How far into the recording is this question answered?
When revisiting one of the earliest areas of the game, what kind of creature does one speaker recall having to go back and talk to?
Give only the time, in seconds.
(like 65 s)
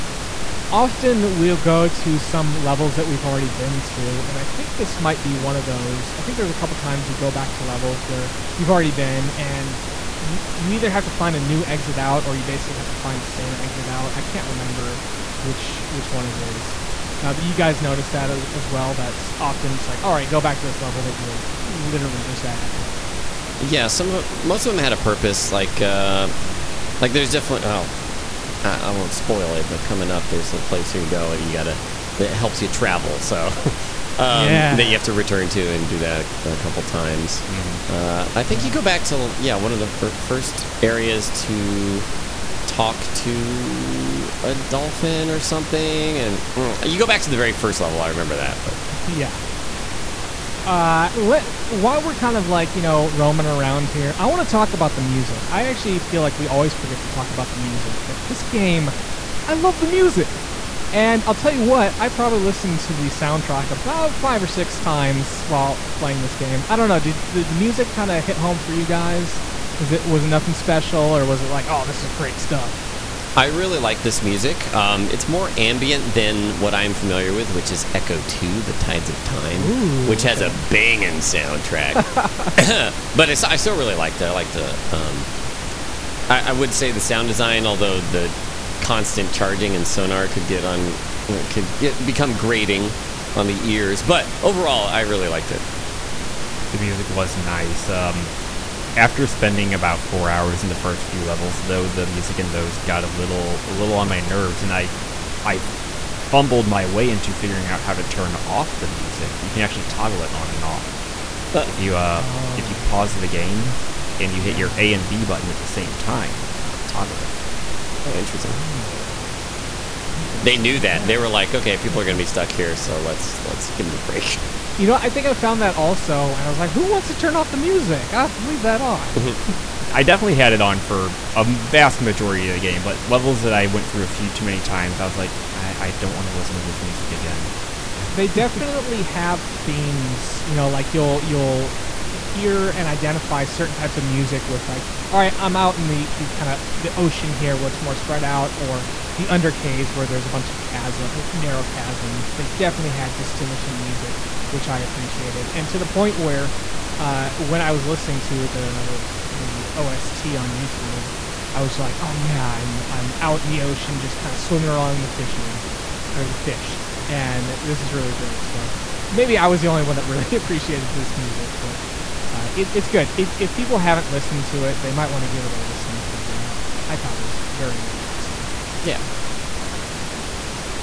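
44 s.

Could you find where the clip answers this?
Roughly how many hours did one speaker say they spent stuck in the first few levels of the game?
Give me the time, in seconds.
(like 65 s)
100 s.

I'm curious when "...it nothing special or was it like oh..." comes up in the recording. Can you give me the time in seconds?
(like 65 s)
70 s.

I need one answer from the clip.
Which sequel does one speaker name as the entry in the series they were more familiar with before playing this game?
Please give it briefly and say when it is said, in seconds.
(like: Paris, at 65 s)
Ecco 2: The Tides of Time, at 77 s.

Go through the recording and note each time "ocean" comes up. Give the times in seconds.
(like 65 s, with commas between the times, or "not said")
146 s, 163 s.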